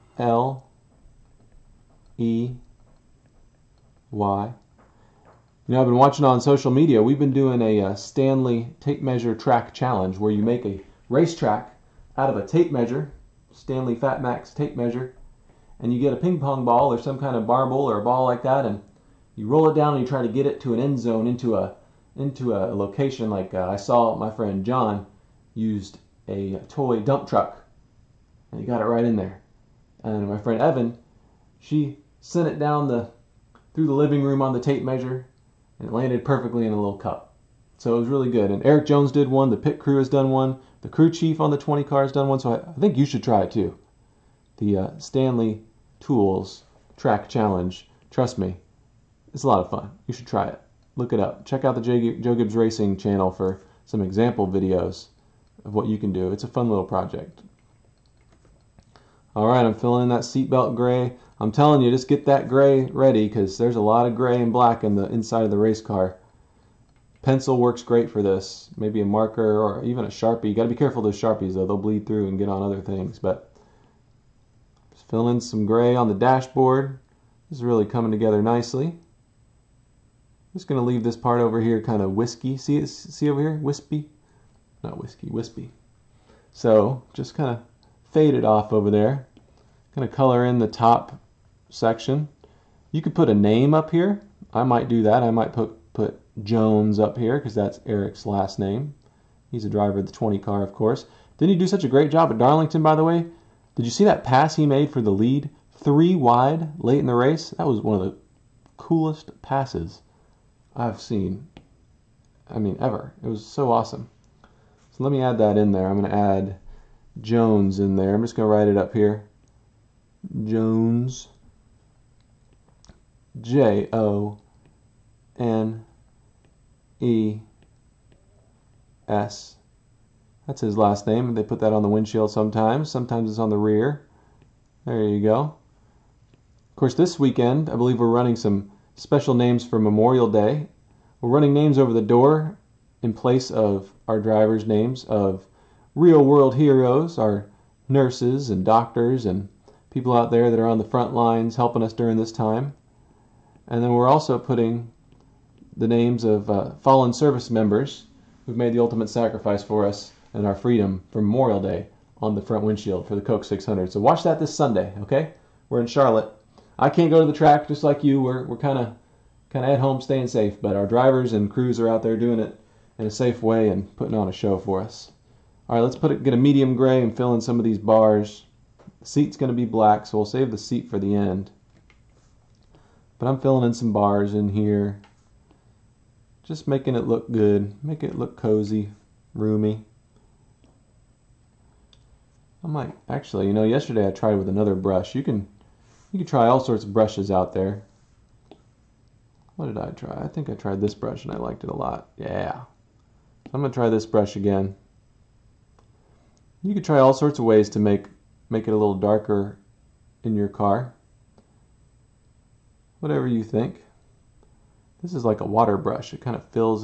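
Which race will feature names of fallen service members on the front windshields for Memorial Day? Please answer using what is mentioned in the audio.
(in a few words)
Coke 600.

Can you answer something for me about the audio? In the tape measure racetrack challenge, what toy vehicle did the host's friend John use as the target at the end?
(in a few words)
Toy dump truck.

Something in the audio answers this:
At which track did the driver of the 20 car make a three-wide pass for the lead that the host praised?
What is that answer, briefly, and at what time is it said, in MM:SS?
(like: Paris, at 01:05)
Darlington, at 01:42.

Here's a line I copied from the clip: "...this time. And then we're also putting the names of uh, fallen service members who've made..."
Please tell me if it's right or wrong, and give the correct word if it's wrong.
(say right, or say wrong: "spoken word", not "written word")
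right.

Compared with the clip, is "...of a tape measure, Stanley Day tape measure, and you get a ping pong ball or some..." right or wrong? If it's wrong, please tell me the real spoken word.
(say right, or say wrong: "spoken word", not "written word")
wrong: "FatMax", not "Day".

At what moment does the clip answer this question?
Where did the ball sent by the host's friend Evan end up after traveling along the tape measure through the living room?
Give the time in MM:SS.
00:36.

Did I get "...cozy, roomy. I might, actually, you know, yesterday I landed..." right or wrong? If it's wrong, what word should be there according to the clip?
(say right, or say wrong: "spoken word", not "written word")
wrong: "tried", not "landed".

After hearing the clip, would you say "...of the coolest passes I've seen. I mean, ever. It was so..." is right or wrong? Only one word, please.
right.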